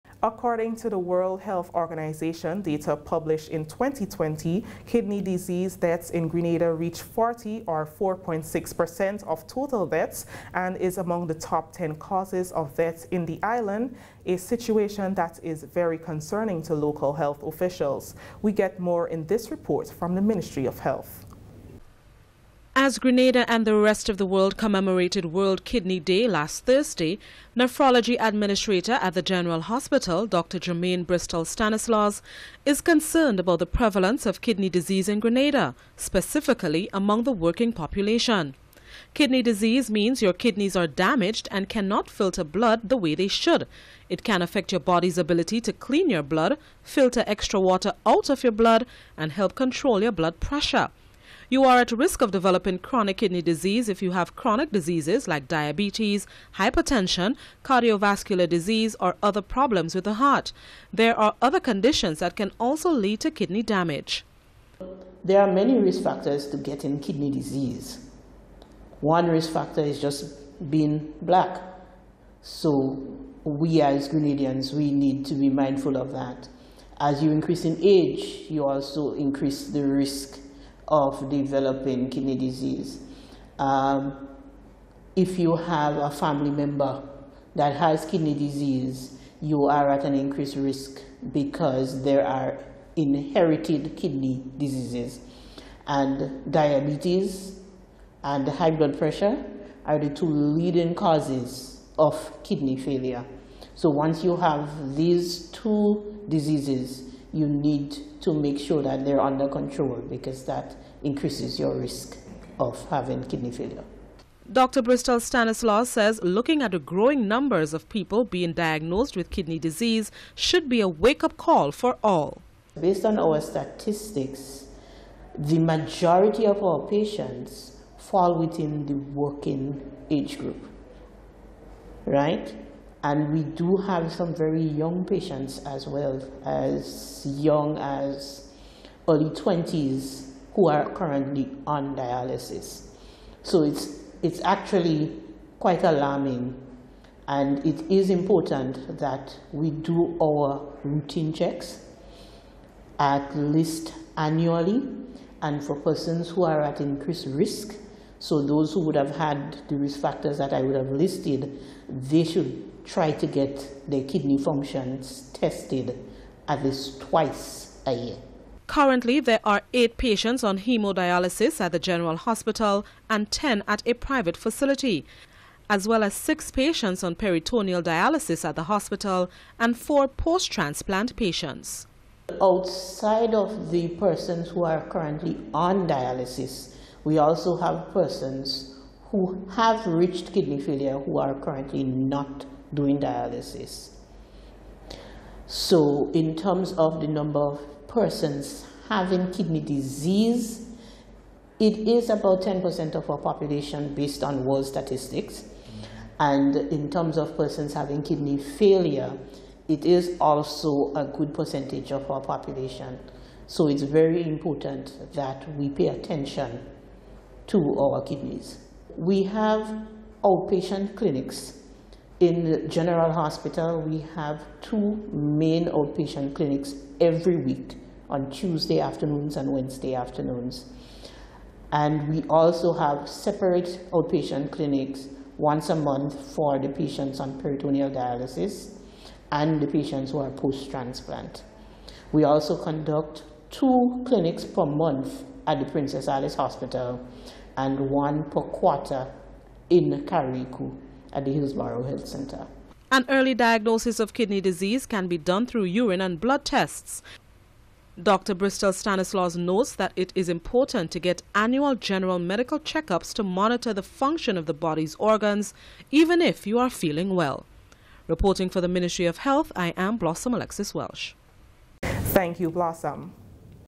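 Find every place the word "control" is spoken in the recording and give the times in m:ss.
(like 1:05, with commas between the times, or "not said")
0:49, 1:49.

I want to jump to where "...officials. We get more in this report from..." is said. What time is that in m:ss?
0:17.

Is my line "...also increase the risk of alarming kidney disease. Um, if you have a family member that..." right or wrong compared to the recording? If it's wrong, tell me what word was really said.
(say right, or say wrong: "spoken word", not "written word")
wrong: "developing", not "alarming".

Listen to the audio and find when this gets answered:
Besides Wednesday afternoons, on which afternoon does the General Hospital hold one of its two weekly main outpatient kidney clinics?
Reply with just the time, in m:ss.
3:48.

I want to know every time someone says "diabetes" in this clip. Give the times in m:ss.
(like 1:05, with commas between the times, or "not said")
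0:55, 1:36.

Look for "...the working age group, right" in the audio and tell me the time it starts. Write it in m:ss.
2:08.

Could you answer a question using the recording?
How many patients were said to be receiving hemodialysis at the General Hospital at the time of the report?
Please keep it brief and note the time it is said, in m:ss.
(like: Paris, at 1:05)
8, at 2:49.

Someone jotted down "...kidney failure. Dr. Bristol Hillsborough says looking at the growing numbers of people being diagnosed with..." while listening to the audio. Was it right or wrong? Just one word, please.
wrong.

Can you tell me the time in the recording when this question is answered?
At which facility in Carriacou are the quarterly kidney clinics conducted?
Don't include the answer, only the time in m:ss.
4:11.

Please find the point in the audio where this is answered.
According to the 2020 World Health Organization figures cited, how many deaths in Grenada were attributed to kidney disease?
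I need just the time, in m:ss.
0:07.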